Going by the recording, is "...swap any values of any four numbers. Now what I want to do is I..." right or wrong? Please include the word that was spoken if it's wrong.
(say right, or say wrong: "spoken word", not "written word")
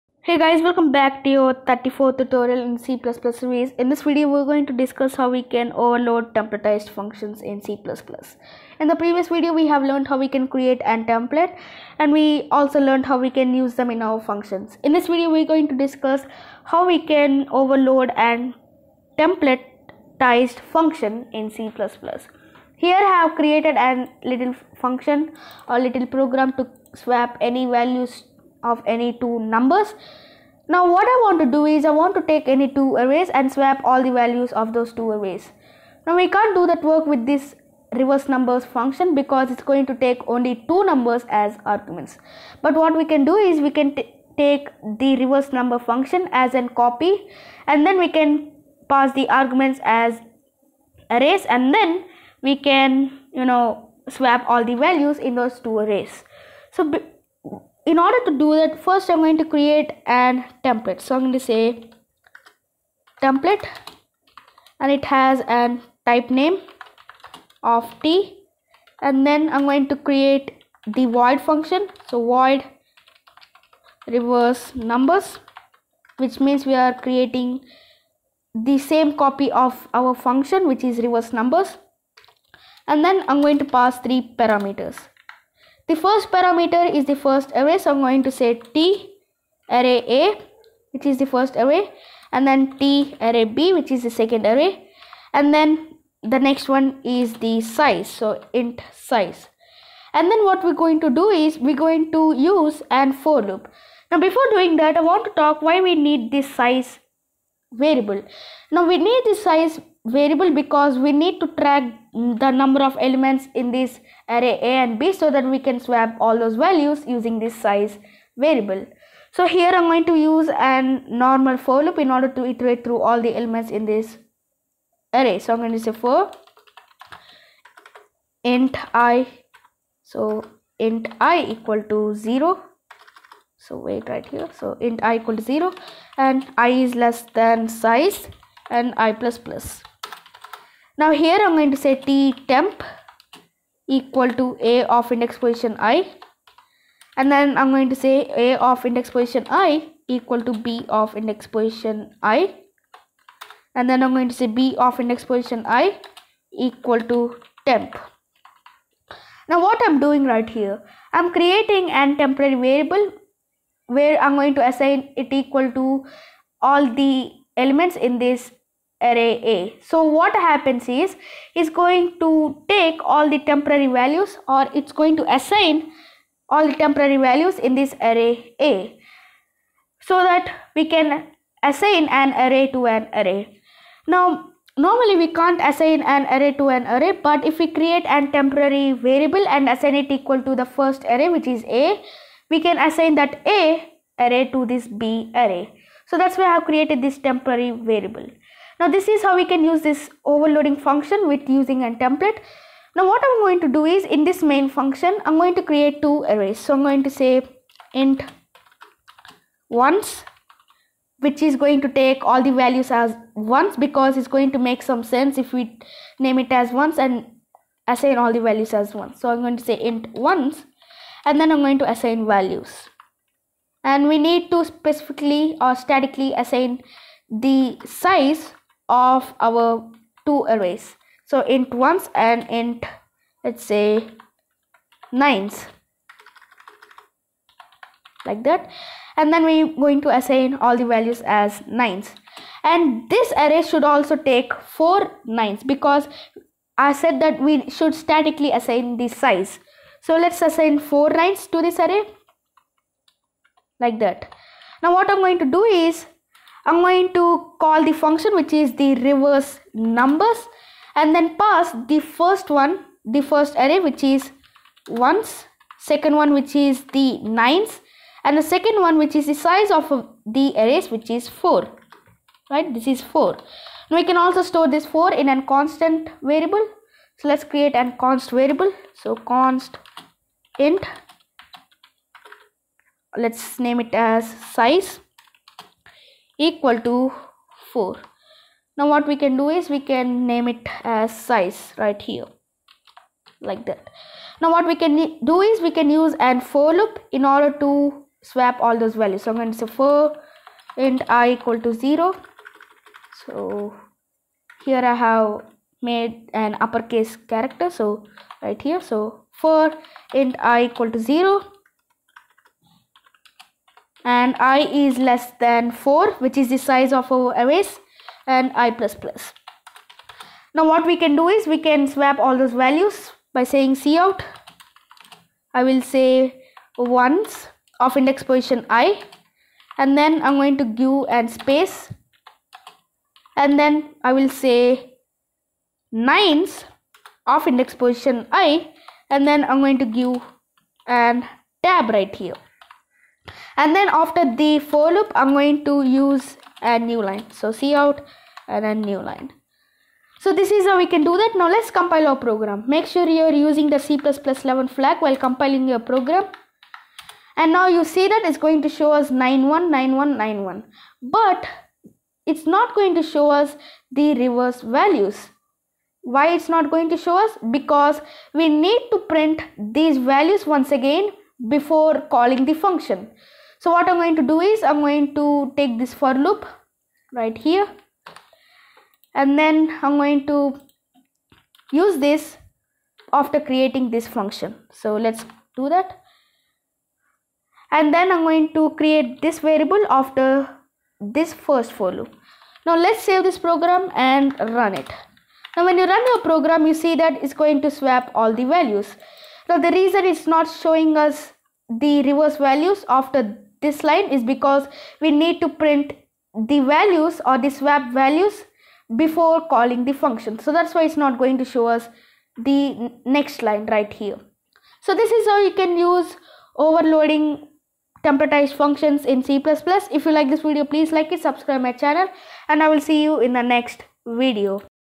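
wrong: "two", not "four".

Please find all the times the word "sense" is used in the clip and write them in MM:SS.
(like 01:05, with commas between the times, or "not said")
03:35.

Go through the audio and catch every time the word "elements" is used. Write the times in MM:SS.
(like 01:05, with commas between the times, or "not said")
01:52, 02:03, 02:47.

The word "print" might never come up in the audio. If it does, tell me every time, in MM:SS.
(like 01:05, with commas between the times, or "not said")
06:09, 06:45.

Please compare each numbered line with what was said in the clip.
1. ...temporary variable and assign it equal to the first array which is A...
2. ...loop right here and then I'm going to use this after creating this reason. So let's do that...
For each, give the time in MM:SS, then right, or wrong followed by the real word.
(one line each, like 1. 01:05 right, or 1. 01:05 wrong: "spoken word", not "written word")
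1. 03:08 right
2. 06:16 wrong: "function", not "reason".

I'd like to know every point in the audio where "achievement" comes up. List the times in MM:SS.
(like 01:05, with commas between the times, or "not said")
not said.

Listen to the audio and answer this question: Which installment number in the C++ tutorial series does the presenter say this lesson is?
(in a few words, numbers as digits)
34th.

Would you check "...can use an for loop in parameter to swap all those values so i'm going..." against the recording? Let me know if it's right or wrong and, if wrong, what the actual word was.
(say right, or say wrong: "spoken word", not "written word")
wrong: "order", not "parameter".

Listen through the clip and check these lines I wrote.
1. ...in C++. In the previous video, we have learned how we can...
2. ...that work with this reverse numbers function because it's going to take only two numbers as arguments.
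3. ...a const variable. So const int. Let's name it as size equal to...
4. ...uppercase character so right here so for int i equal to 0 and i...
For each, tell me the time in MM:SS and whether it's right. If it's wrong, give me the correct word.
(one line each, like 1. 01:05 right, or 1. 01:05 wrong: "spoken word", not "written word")
1. 00:07 right
2. 00:36 right
3. 04:37 right
4. 05:06 right.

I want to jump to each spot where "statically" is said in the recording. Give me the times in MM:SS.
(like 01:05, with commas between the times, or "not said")
03:45, 04:07.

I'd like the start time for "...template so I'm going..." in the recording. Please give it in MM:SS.
01:00.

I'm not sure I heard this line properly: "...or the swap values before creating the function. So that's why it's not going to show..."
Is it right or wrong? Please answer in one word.
wrong.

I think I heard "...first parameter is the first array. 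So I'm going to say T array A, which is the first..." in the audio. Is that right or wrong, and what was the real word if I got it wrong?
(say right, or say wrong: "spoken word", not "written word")
right.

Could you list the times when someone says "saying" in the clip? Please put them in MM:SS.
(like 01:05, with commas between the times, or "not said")
05:23.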